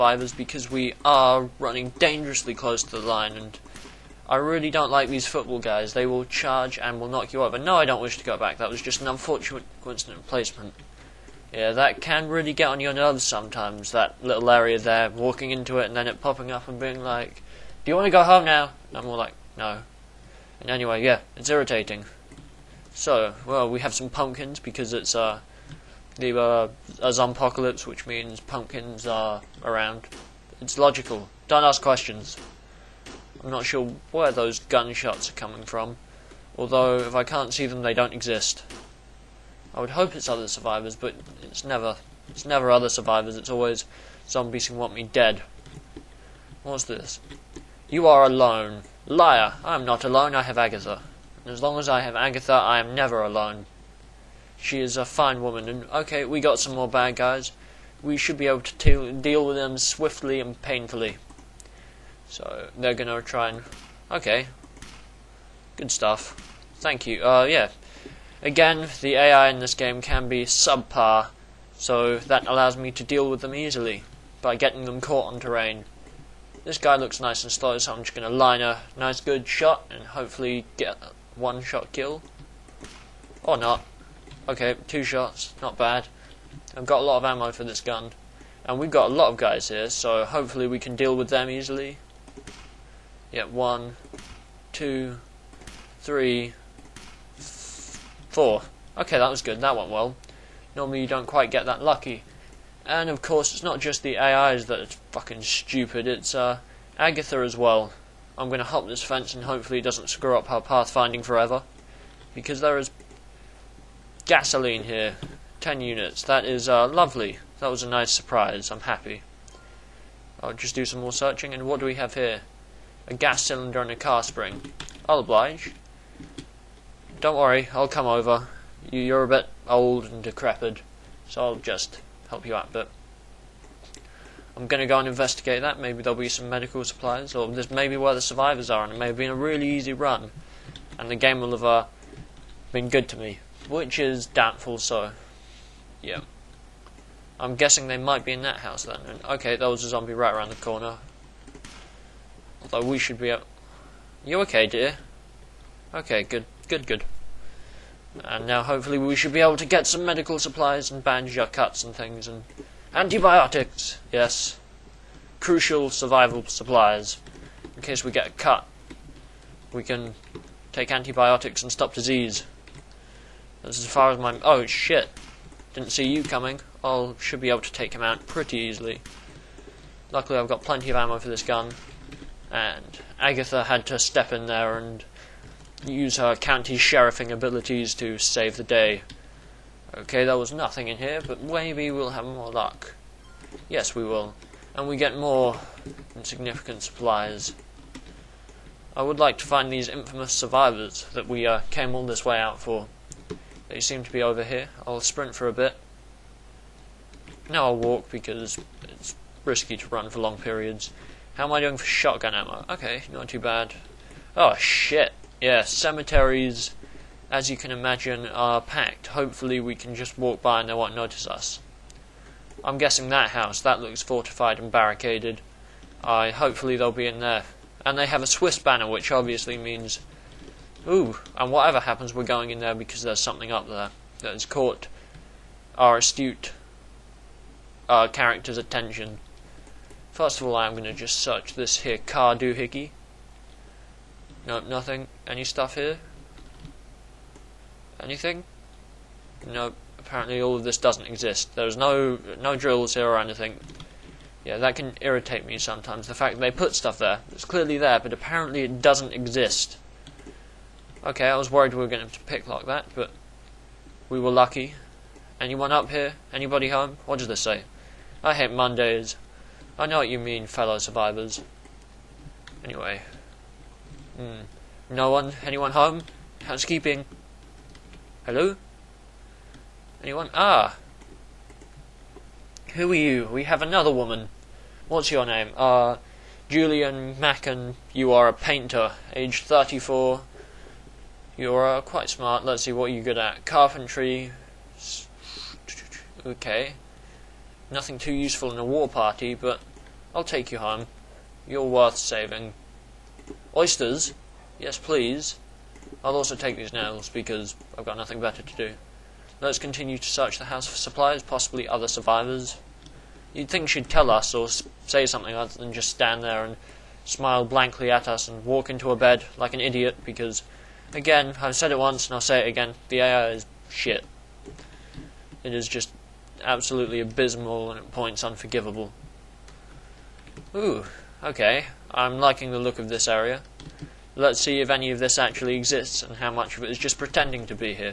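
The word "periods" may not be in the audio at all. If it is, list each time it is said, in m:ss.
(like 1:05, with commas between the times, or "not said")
3:30.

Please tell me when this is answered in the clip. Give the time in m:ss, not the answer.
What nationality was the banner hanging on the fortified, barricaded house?
3:48.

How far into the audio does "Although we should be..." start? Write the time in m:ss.
2:32.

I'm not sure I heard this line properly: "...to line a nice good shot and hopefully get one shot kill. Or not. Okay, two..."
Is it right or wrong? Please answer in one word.
right.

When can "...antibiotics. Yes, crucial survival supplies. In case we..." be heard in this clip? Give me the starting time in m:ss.
2:42.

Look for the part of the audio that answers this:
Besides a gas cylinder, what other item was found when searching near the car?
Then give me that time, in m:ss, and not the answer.
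2:03.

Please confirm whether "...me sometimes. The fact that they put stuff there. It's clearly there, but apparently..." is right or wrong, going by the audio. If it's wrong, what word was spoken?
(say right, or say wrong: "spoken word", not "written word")
right.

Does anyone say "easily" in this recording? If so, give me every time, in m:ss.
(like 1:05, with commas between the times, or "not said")
1:13, 1:31, 2:58.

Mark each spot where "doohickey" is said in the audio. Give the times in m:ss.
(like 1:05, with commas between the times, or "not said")
4:02.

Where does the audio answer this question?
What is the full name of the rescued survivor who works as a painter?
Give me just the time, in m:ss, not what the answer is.
4:46.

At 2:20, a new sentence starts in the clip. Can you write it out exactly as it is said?
And the game will have uh, been good to me which is doubtful, so yeah.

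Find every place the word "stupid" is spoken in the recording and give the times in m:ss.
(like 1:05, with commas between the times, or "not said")
1:45.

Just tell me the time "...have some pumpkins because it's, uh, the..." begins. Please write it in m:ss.
0:23.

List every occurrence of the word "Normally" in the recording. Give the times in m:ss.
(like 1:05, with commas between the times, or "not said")
1:40.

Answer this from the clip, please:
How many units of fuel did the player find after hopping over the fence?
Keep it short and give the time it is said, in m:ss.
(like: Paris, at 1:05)
10, at 1:55.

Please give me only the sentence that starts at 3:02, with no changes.
And Agatha had to step in there and use her county sheriffing abilities to save the day.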